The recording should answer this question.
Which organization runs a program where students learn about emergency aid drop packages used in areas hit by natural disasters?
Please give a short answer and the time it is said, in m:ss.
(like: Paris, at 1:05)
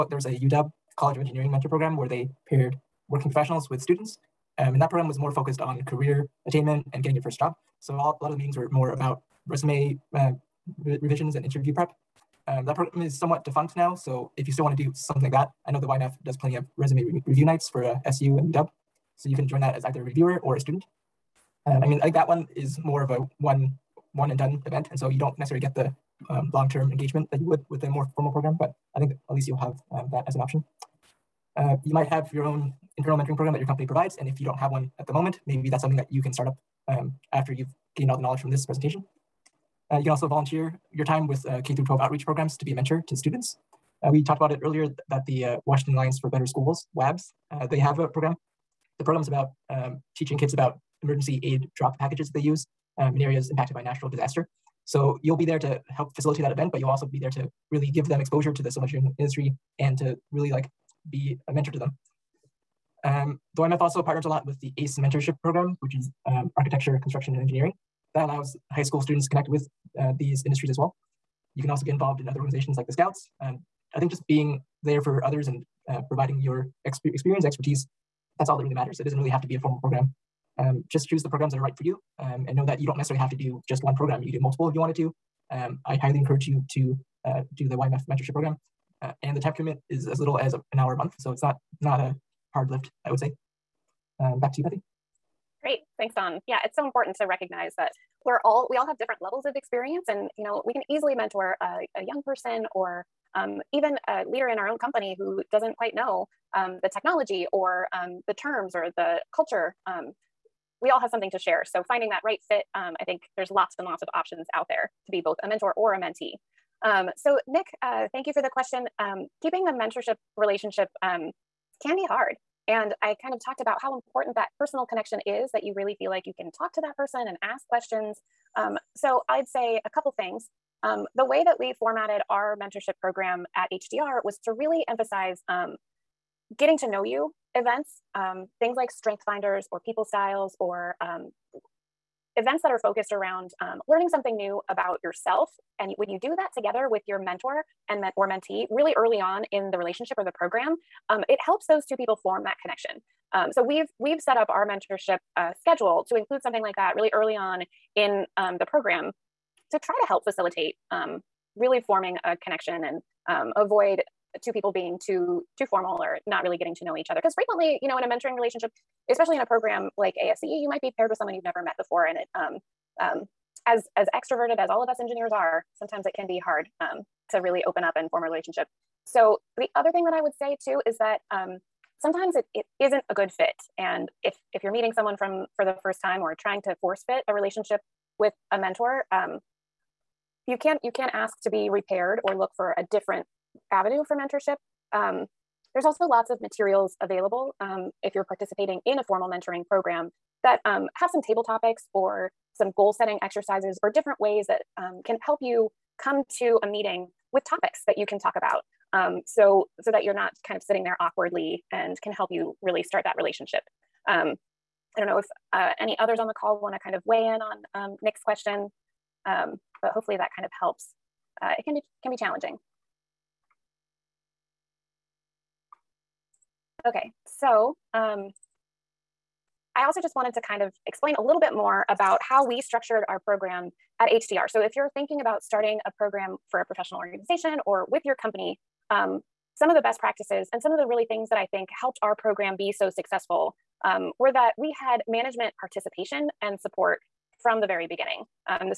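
Washington Alliance for Better Schools, at 0:45.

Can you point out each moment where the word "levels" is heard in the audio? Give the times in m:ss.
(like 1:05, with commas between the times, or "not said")
1:39.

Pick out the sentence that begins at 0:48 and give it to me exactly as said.
The program is about um, teaching kids about emergency aid drop packages that they use um, in areas impacted by natural disaster.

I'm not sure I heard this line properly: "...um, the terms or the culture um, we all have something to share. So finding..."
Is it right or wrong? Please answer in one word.
right.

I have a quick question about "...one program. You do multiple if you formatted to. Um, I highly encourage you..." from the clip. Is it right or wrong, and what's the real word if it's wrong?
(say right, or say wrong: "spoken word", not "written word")
wrong: "wanted", not "formatted".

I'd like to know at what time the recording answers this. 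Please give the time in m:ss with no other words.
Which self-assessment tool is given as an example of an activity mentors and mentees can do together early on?
2:18.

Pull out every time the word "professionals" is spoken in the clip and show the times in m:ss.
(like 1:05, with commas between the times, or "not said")
0:03, 3:56.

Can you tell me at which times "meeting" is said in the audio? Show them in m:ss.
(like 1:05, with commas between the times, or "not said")
0:08, 3:04, 3:26.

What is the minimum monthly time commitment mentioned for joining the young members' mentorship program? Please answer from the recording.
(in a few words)
1 hour a month.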